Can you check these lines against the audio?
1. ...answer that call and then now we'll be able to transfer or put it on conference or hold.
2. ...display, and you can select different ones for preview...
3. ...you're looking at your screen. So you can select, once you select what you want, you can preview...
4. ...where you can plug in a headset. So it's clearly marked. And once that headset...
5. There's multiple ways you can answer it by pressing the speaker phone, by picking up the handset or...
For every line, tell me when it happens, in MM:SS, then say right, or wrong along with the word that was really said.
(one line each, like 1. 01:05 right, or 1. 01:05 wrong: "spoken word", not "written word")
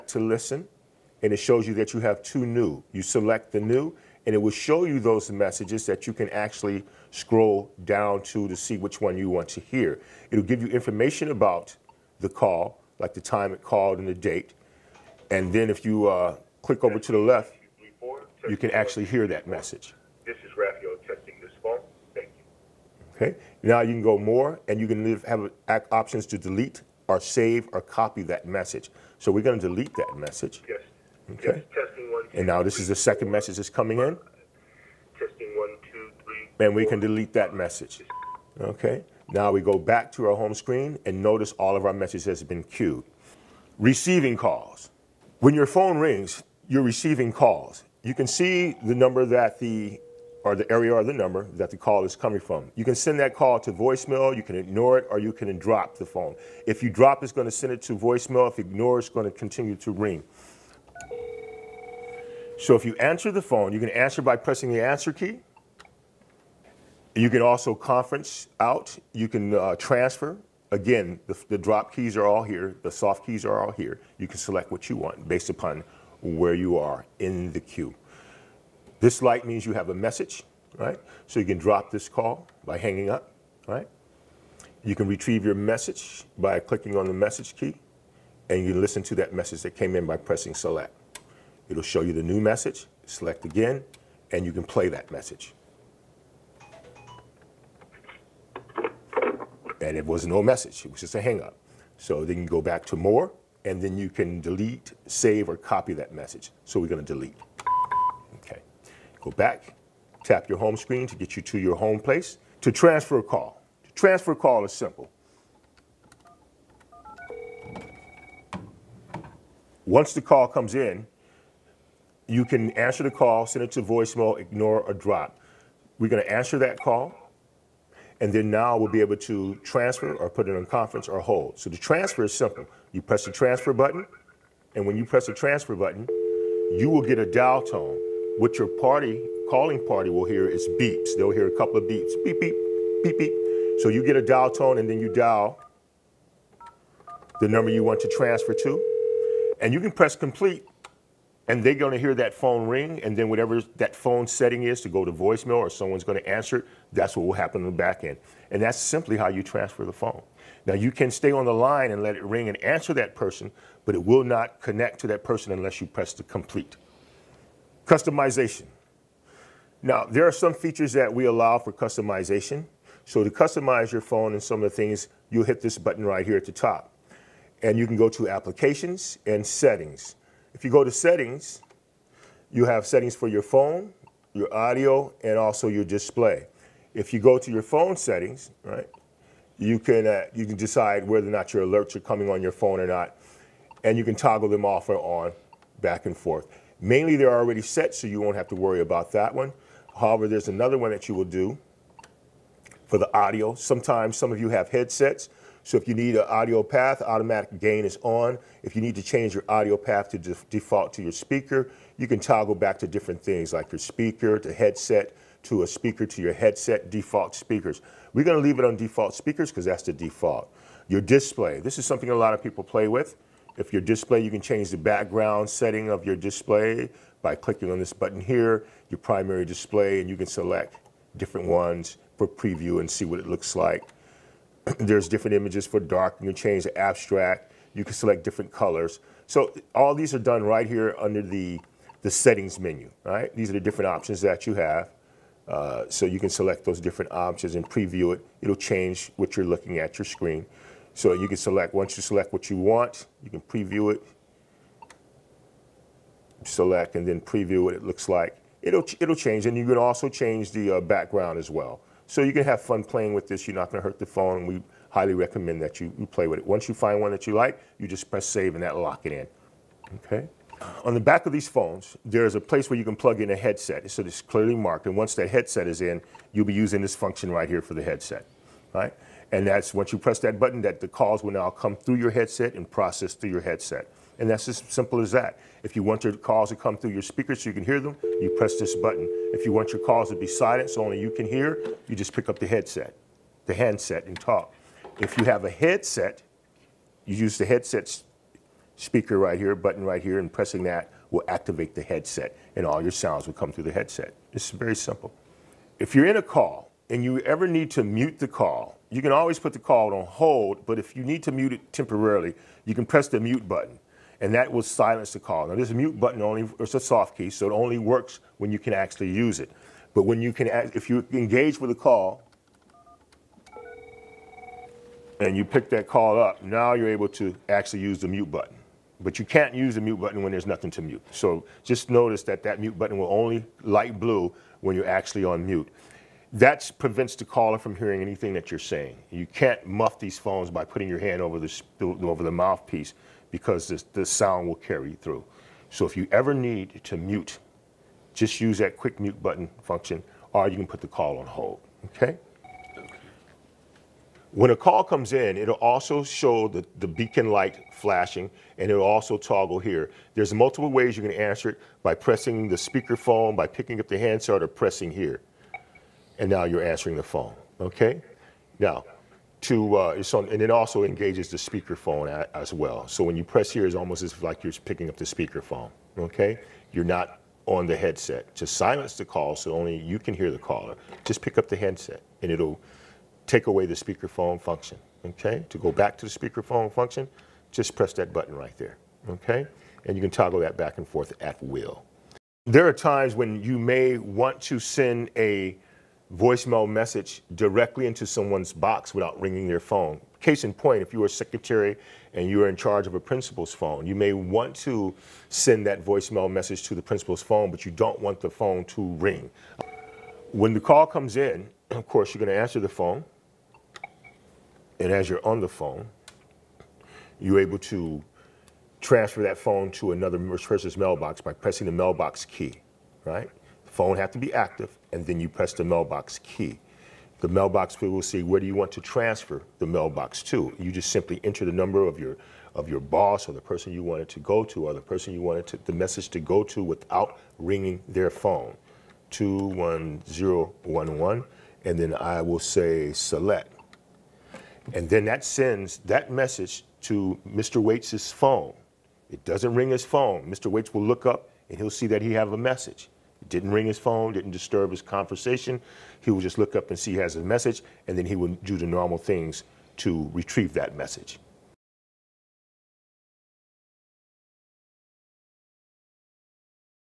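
1. 02:06 right
2. 03:49 right
3. 04:09 right
4. 04:32 right
5. 06:00 right.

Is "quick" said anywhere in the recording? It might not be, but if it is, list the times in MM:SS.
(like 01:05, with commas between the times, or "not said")
05:48.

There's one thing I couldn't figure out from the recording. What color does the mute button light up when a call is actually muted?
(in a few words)
blue.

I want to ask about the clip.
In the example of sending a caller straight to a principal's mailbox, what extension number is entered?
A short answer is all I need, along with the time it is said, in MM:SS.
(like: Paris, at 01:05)
21011, at 07:19.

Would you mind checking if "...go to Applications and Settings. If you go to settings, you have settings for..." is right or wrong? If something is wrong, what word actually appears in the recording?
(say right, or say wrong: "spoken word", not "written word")
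right.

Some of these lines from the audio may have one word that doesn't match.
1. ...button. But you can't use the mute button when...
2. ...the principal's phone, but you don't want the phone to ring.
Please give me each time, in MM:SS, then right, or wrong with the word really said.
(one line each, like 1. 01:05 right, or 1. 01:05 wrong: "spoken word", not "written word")
1. 05:28 right
2. 06:46 right.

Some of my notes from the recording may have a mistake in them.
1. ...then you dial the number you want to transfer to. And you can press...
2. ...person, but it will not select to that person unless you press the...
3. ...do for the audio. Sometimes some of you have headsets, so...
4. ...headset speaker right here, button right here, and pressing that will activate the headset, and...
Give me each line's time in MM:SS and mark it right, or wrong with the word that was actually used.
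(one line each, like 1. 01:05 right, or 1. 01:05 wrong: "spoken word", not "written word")
1. 02:24 right
2. 02:43 wrong: "connect", not "select"
3. 03:21 right
4. 04:57 right.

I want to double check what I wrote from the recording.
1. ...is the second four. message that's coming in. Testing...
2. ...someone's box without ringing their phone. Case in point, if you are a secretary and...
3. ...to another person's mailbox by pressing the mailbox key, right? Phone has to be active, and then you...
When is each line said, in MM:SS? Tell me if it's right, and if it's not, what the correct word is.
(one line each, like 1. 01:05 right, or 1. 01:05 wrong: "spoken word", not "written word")
1. 00:32 right
2. 06:38 right
3. 06:59 right.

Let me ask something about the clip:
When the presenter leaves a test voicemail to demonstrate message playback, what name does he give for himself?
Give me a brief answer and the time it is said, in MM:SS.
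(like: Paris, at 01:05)
Raphael, at 00:20.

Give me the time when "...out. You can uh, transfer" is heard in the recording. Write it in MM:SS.
01:08.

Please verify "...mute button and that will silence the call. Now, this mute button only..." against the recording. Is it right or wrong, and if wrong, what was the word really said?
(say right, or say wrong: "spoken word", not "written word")
right.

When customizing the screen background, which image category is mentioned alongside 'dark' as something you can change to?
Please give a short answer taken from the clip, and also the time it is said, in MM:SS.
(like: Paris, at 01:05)
abstract, at 03:56.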